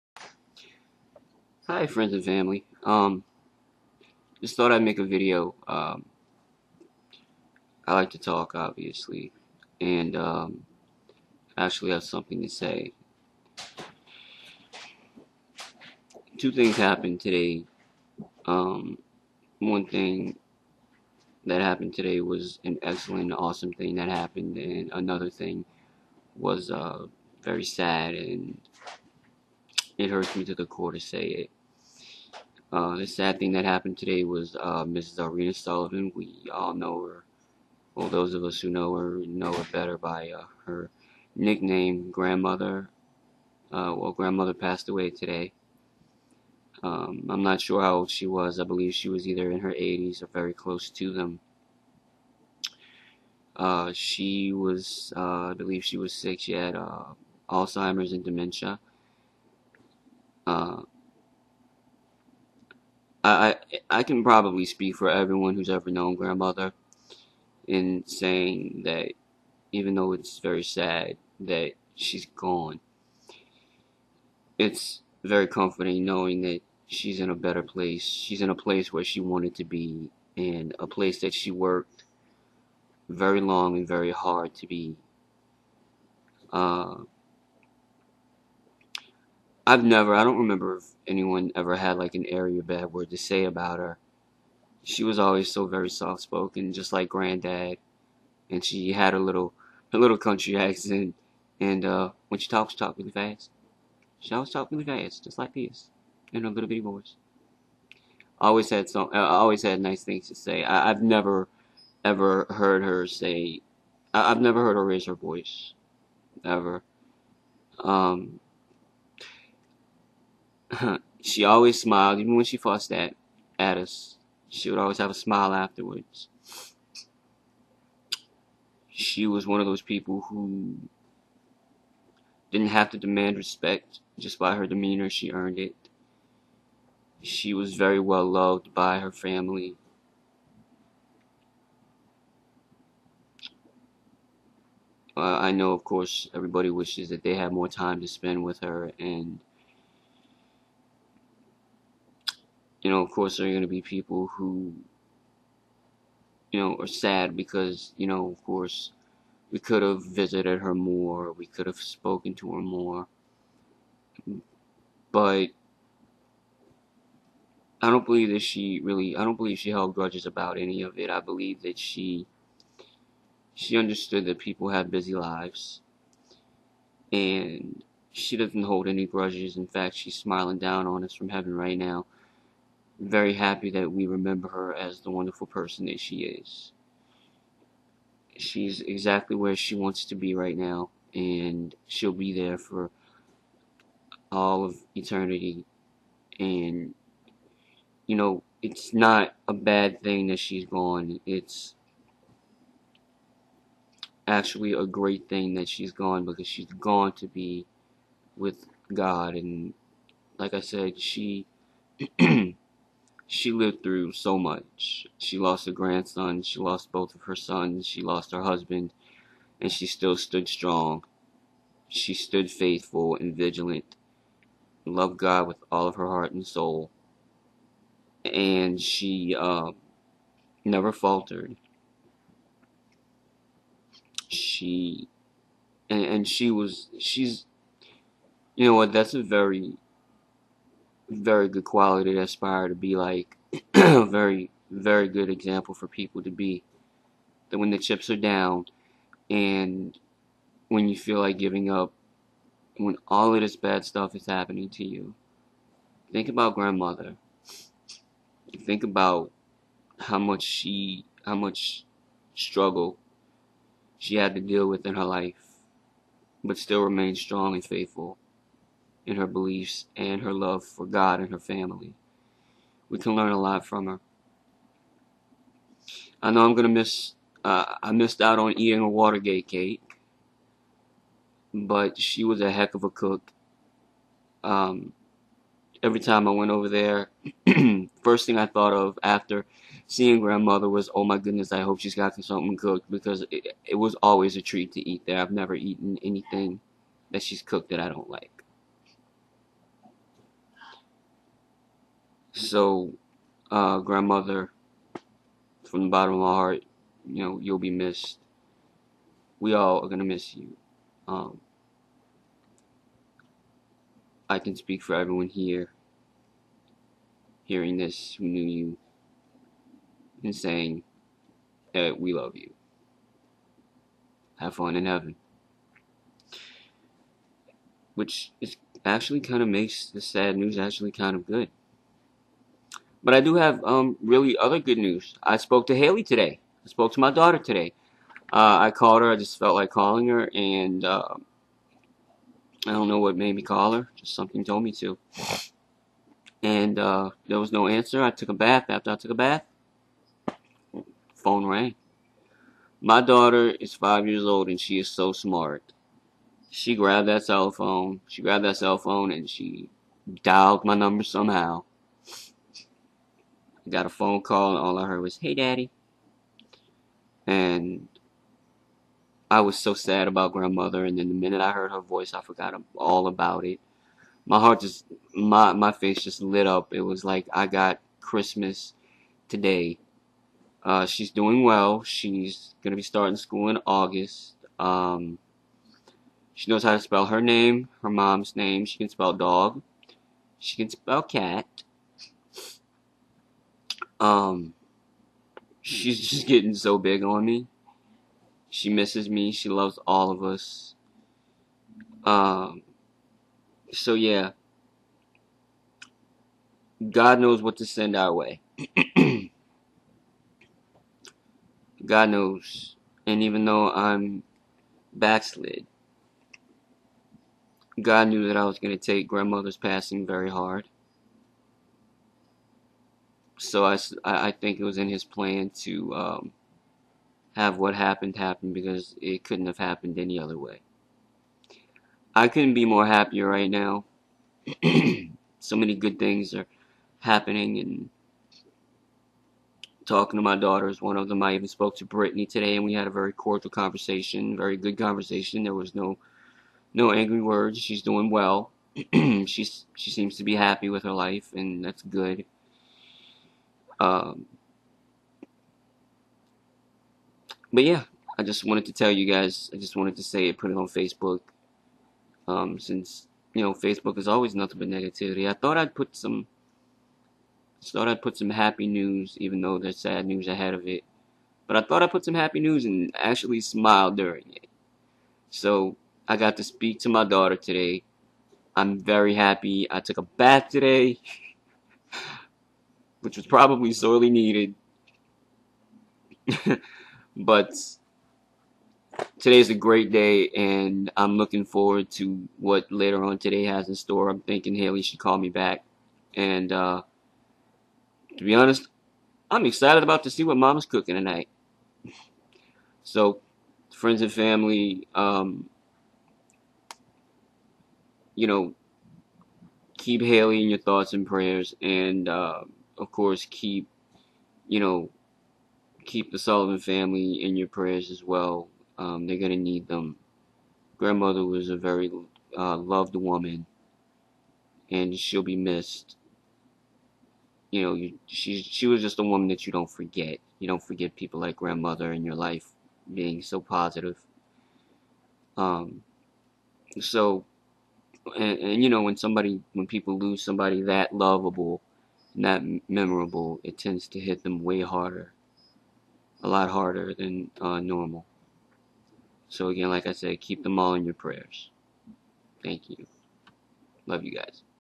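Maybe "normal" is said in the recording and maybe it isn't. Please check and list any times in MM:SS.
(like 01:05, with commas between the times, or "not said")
09:07.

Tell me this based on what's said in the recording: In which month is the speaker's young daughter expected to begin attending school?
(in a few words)
August.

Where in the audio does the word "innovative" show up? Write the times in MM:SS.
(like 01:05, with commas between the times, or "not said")
not said.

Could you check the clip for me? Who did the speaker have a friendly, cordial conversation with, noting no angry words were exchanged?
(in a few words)
Brittany.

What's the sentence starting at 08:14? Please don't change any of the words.
I'm thinking Haley should call me back.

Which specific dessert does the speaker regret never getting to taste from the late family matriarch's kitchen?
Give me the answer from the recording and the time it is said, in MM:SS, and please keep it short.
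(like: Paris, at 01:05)
Watergate cake, at 04:38.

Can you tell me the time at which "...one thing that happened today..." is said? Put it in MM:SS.
00:19.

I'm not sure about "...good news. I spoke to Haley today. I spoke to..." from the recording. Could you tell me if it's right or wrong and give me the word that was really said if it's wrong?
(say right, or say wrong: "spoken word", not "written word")
right.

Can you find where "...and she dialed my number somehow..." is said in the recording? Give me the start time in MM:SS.
05:59.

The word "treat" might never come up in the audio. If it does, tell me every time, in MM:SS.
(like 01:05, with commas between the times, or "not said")
04:54.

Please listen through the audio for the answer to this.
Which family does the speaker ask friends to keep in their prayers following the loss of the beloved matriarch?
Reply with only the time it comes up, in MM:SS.
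08:36.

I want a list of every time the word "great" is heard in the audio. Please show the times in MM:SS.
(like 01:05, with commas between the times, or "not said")
03:24, 08:09.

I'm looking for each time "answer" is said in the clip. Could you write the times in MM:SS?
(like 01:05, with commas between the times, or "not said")
05:47.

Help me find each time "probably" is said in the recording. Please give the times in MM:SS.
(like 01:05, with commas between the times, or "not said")
01:04, 08:03.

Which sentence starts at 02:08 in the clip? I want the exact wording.
She was one of those people who didn't have to demand respect.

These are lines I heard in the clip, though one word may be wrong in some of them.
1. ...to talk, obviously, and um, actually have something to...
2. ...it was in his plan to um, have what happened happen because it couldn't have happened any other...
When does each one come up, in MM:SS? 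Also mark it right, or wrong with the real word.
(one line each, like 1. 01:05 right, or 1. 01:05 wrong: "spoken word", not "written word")
1. 00:08 right
2. 07:04 right.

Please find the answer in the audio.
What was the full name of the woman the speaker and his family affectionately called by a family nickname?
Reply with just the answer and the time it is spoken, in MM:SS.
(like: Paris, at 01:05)
Arena Sullivan, at 00:34.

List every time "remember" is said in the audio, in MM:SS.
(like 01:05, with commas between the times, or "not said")
01:30, 03:04.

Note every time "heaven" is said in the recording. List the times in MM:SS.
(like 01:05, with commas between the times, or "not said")
03:01, 05:24.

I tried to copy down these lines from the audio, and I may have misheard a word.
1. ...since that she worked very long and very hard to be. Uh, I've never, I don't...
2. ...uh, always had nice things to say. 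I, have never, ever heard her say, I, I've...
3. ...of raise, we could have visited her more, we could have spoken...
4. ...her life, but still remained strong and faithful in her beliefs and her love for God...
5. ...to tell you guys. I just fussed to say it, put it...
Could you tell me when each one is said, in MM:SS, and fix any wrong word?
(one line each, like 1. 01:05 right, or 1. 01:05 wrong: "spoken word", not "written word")
1. 01:20 wrong: "place", not "since"
2. 01:49 right
3. 02:38 wrong: "course", not "raise"
4. 04:24 right
5. 07:38 wrong: "wanted", not "fussed".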